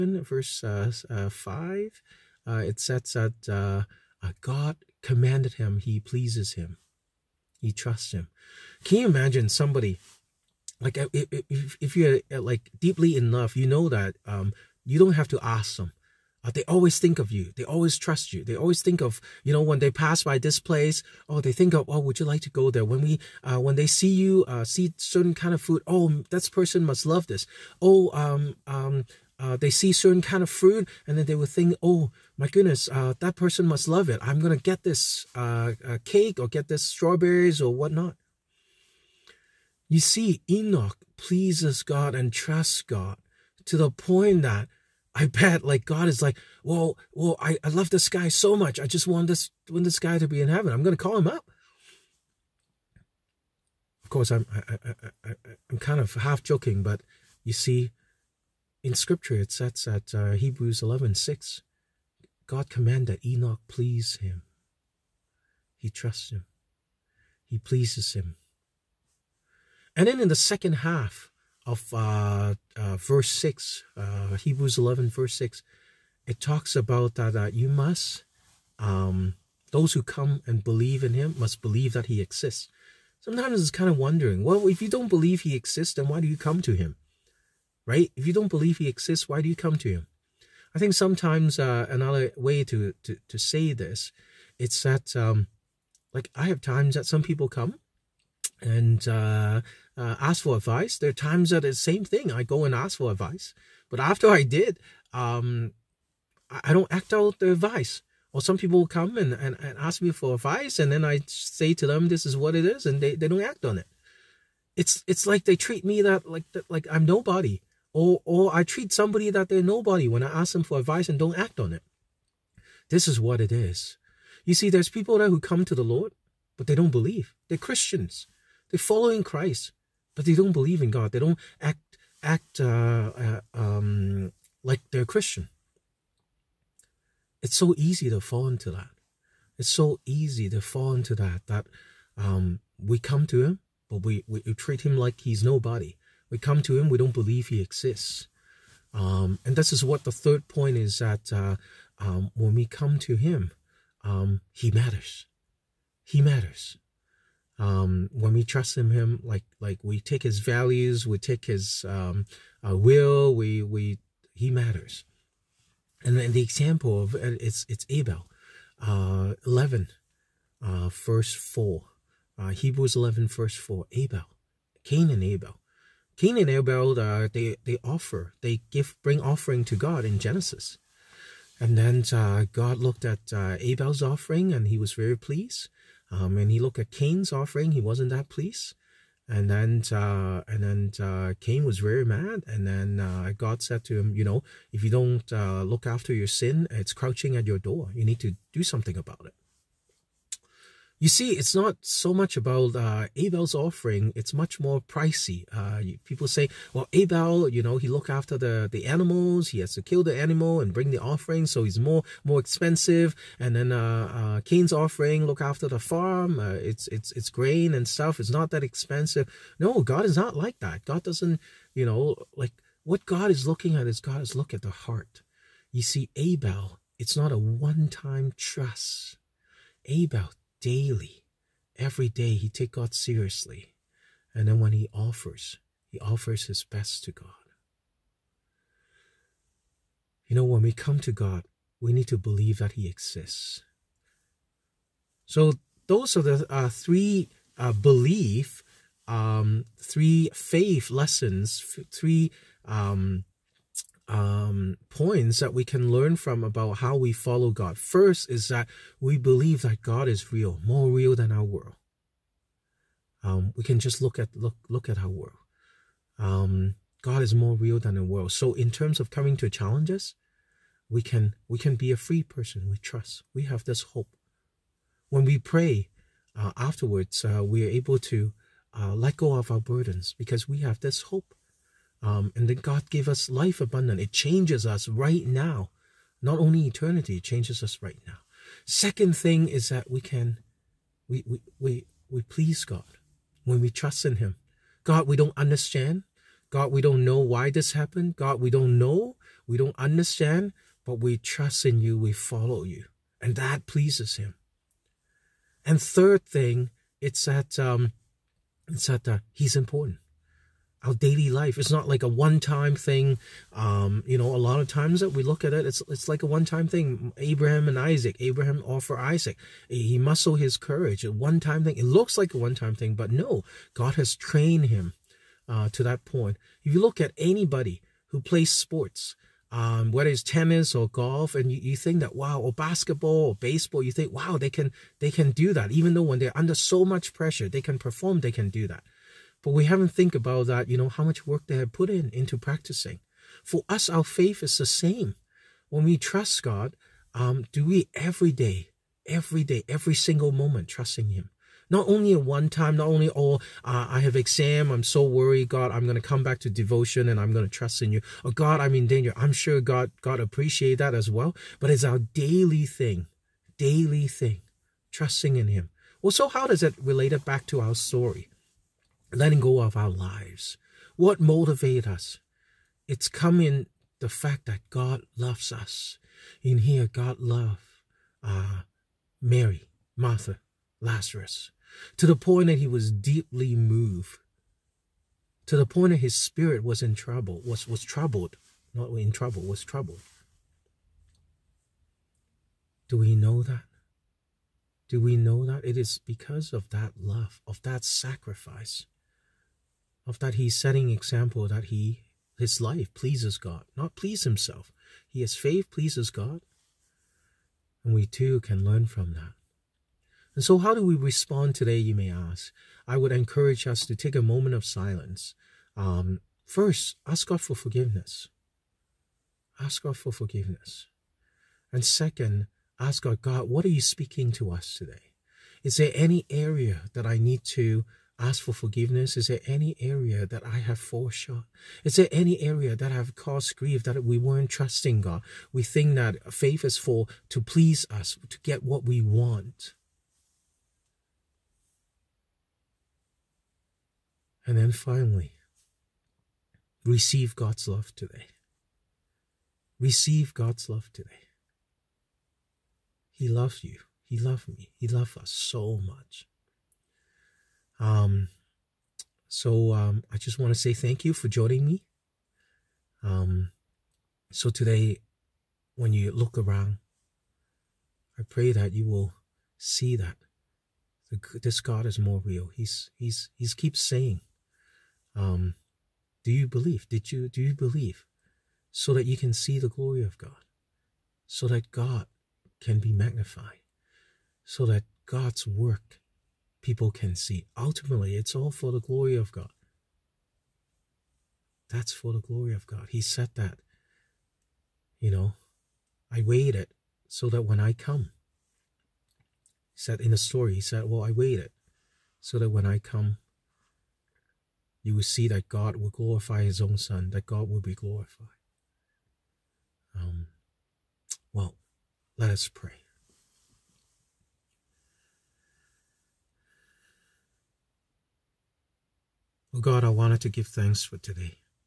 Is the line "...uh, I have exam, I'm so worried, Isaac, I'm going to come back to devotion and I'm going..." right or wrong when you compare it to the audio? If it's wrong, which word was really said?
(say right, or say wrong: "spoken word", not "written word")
wrong: "God", not "Isaac".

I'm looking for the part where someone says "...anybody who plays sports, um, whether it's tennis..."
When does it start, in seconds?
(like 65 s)
327 s.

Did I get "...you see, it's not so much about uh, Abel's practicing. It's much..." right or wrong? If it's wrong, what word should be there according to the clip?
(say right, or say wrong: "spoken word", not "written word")
wrong: "offering", not "practicing".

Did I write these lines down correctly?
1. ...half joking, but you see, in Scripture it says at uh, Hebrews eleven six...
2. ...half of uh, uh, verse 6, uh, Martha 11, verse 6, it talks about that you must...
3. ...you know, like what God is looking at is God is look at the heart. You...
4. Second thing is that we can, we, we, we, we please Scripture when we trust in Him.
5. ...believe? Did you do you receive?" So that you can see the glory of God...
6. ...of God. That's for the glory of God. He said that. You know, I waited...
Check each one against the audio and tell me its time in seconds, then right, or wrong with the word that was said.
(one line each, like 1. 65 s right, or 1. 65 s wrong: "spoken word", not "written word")
1. 56 s right
2. 70 s wrong: "Hebrews", not "Martha"
3. 221 s right
4. 288 s wrong: "God", not "Scripture"
5. 476 s wrong: "believe", not "receive"
6. 489 s right.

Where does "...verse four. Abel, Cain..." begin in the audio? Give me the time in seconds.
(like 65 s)
173 s.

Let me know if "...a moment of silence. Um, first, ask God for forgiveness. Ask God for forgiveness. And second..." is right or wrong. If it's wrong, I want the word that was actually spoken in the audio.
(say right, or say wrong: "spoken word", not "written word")
right.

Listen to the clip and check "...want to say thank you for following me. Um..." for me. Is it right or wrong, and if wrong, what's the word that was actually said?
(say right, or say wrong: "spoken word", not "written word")
wrong: "joining", not "following".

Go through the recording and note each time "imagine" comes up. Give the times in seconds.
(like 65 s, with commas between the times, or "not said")
9 s.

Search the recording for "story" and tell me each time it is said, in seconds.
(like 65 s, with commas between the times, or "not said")
367 s, 500 s.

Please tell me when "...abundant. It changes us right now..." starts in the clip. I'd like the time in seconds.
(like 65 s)
283 s.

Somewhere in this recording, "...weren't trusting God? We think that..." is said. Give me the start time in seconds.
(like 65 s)
434 s.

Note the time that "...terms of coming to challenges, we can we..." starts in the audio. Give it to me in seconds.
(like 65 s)
268 s.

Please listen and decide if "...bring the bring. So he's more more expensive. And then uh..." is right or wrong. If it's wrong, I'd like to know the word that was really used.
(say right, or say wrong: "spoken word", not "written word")
wrong: "offering", not "bring".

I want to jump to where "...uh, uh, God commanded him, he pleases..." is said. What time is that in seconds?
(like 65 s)
3 s.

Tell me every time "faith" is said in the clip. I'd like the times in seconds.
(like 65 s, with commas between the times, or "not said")
250 s, 344 s, 405 s, 436 s.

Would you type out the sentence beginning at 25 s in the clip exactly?
Oh, that person must love this.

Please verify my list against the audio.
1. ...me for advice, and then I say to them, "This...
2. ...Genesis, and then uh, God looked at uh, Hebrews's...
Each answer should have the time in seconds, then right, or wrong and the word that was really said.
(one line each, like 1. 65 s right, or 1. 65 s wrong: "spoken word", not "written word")
1. 110 s right
2. 180 s wrong: "Abel", not "Hebrews".